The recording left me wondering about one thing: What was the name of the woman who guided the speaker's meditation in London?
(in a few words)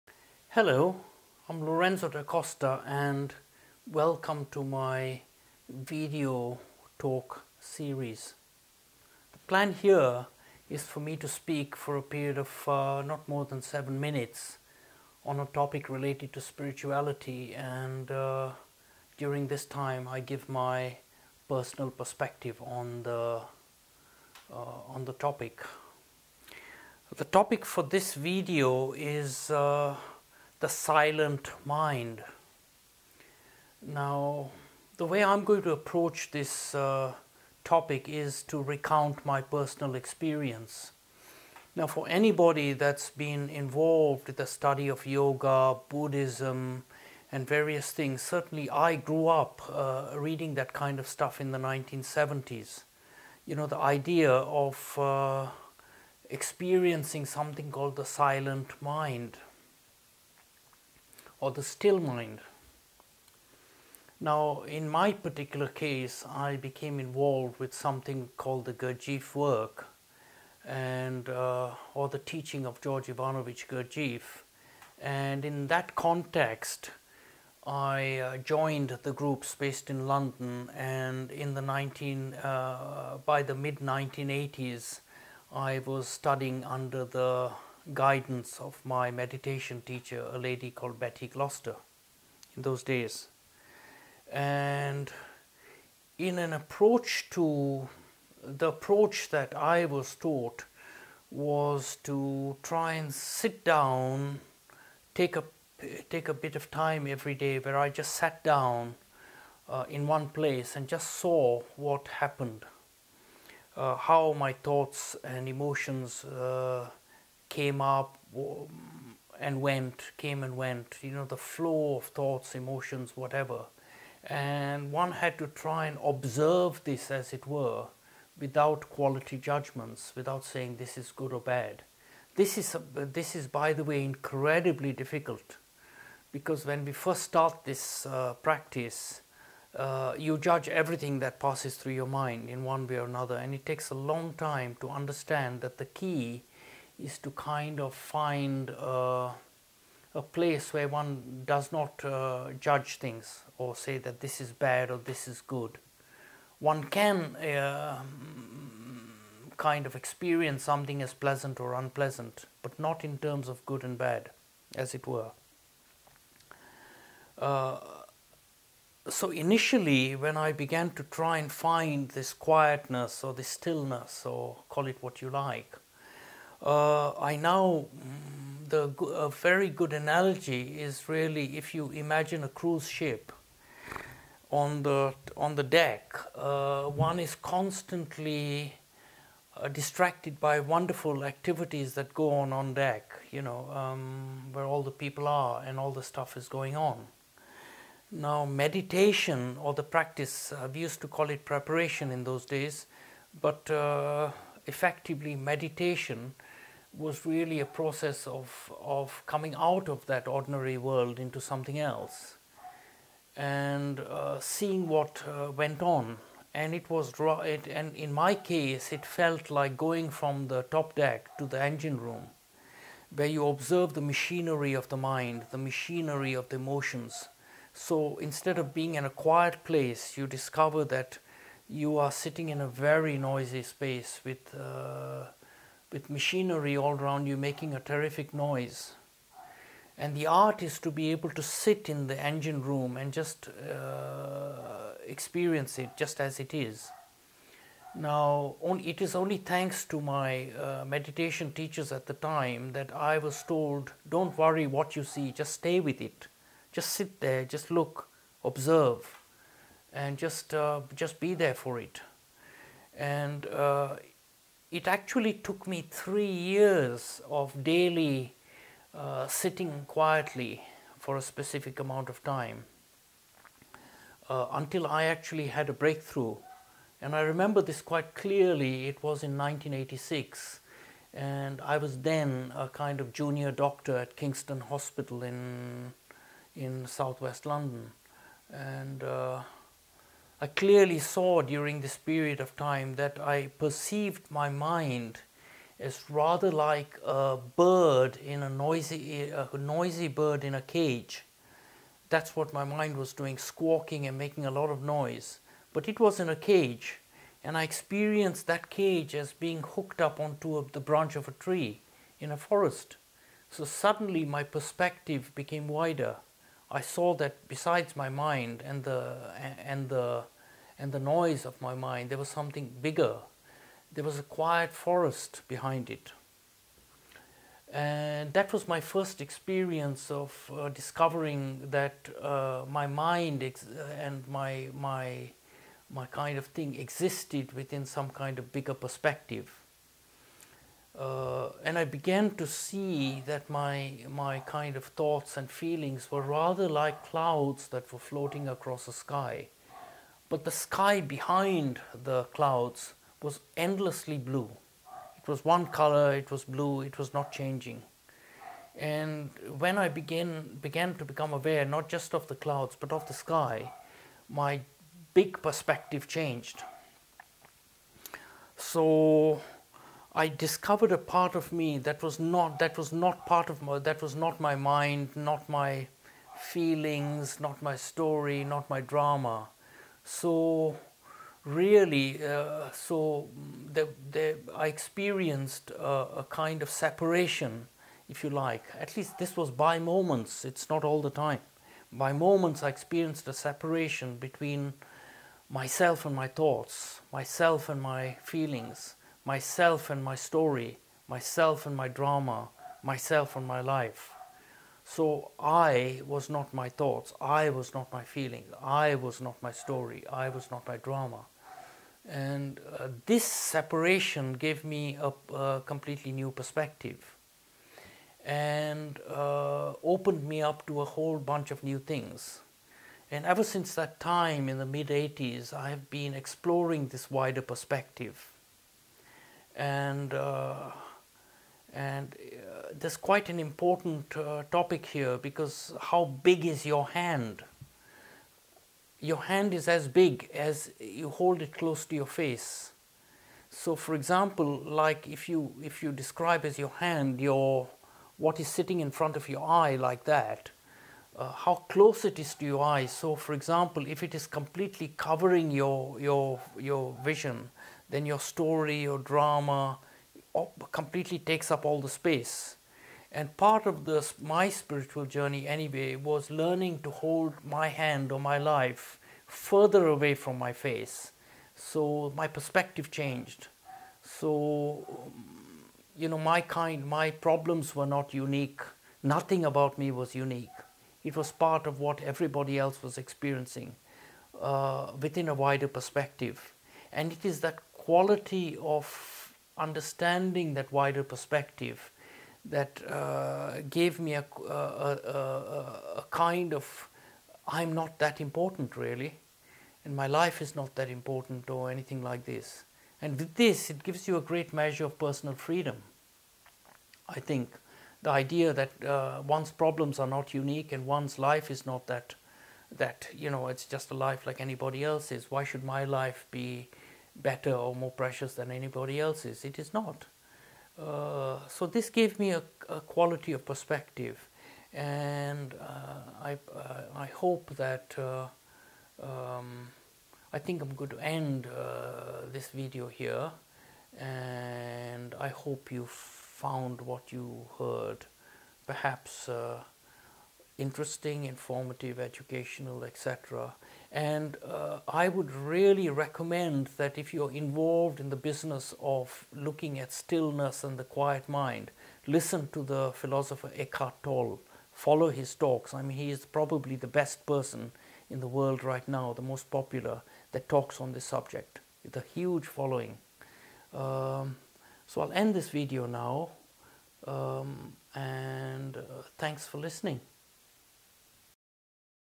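Betty Gloucester.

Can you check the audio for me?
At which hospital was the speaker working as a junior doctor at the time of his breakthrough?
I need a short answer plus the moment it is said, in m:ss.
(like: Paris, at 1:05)
Kingston Hospital, at 4:44.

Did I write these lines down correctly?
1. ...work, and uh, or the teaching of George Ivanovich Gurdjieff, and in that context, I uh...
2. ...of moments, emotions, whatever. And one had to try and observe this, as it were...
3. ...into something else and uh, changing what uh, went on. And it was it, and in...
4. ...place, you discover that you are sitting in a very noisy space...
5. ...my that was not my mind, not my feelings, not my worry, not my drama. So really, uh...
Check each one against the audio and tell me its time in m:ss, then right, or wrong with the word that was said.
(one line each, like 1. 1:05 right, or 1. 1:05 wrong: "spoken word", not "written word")
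1. 1:09 right
2. 2:01 wrong: "thoughts", not "moments"
3. 3:31 wrong: "seeing", not "changing"
4. 3:49 right
5. 6:13 wrong: "story", not "worry".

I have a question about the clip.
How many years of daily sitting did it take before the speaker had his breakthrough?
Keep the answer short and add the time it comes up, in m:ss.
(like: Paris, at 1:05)
3 years, at 4:25.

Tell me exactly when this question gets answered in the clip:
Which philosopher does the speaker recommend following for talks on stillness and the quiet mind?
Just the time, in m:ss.
9:13.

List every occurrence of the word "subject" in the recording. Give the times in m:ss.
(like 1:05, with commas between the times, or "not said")
9:21.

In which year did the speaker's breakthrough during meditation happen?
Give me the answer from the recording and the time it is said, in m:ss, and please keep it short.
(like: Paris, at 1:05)
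1986, at 4:39.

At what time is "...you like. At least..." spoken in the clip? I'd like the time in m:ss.
6:28.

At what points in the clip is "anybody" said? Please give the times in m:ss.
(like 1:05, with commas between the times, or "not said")
0:42, 8:34, 8:38.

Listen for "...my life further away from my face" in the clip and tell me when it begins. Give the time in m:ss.
7:48.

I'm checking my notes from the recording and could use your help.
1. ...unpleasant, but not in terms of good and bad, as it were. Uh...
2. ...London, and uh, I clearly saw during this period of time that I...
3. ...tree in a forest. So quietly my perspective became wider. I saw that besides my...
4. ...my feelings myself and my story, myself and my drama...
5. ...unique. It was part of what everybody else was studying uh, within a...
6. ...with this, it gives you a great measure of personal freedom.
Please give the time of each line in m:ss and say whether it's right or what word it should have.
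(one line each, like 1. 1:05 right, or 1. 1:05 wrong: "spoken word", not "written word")
1. 2:41 right
2. 4:47 right
3. 5:11 wrong: "suddenly", not "quietly"
4. 6:37 right
5. 8:00 wrong: "experiencing", not "studying"
6. 8:23 right.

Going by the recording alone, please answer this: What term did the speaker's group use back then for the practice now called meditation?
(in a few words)
Preparation.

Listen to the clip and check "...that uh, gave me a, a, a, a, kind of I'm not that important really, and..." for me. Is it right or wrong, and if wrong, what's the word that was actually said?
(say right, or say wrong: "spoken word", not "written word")
right.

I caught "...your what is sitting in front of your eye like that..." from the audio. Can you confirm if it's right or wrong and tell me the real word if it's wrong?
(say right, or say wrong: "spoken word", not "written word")
right.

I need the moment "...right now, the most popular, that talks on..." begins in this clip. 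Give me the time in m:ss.
9:18.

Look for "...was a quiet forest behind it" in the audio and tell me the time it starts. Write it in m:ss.
5:24.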